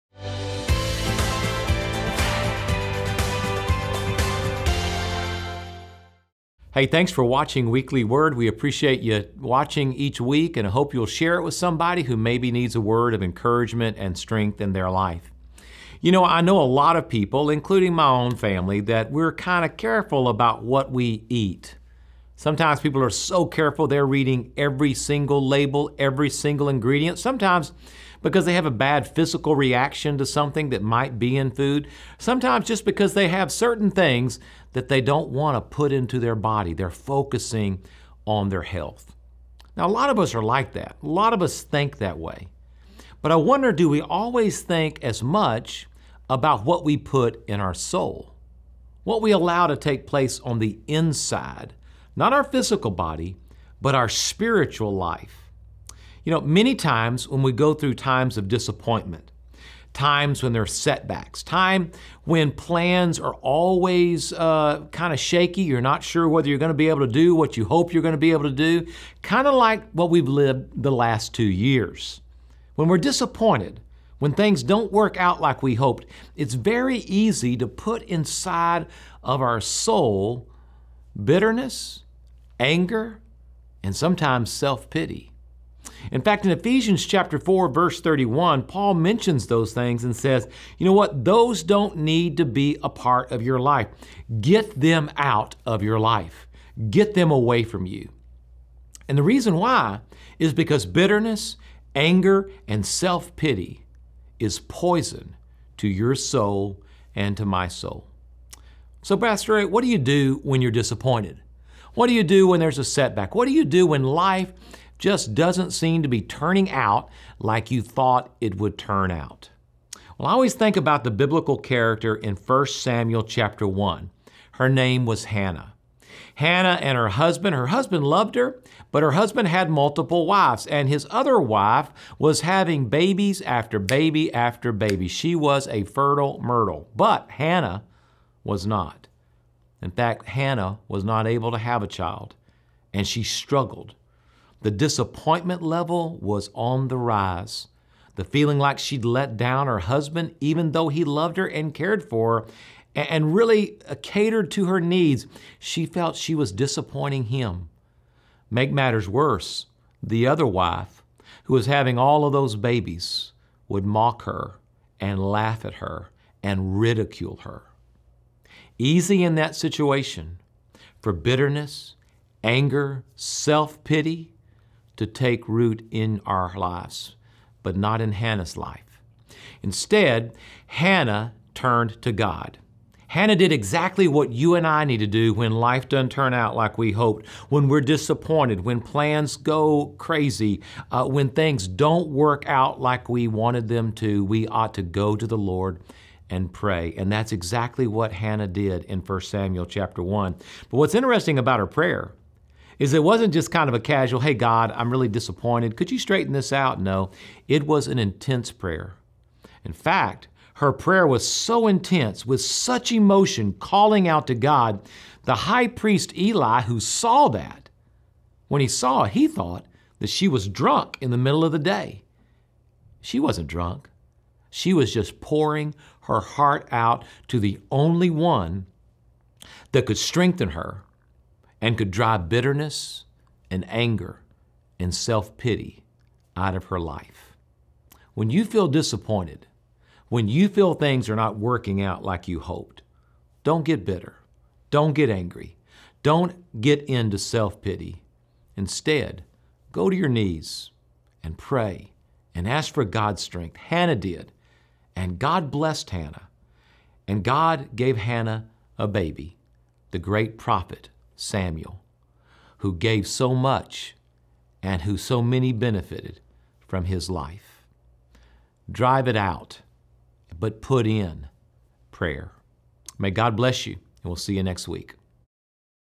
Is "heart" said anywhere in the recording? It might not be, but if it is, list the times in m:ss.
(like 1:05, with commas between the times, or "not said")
3:46.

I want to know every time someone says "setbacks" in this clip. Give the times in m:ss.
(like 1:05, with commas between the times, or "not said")
1:00, 1:52.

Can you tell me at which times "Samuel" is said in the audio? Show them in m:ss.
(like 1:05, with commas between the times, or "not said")
2:02, 3:19, 4:21.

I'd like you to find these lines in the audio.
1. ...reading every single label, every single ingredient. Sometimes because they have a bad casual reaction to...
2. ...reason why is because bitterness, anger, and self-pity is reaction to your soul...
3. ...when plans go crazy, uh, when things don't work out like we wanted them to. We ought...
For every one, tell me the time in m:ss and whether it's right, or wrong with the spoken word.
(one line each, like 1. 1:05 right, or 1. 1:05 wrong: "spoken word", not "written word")
1. 0:24 wrong: "physical", not "casual"
2. 1:39 wrong: "poison", not "reaction"
3. 3:08 right.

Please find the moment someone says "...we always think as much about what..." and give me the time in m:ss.
0:43.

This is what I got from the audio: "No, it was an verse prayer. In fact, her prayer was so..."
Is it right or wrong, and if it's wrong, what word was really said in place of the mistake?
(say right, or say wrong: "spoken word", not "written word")
wrong: "intense", not "verse".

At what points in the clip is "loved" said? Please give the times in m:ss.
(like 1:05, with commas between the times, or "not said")
2:08, 2:31.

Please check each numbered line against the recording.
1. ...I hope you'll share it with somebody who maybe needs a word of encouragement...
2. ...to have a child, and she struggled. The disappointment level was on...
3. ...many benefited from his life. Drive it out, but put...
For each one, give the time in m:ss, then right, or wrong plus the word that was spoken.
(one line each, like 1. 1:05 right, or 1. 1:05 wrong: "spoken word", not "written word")
1. 0:10 right
2. 2:21 right
3. 4:25 right.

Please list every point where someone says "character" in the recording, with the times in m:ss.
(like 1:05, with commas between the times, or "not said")
2:01.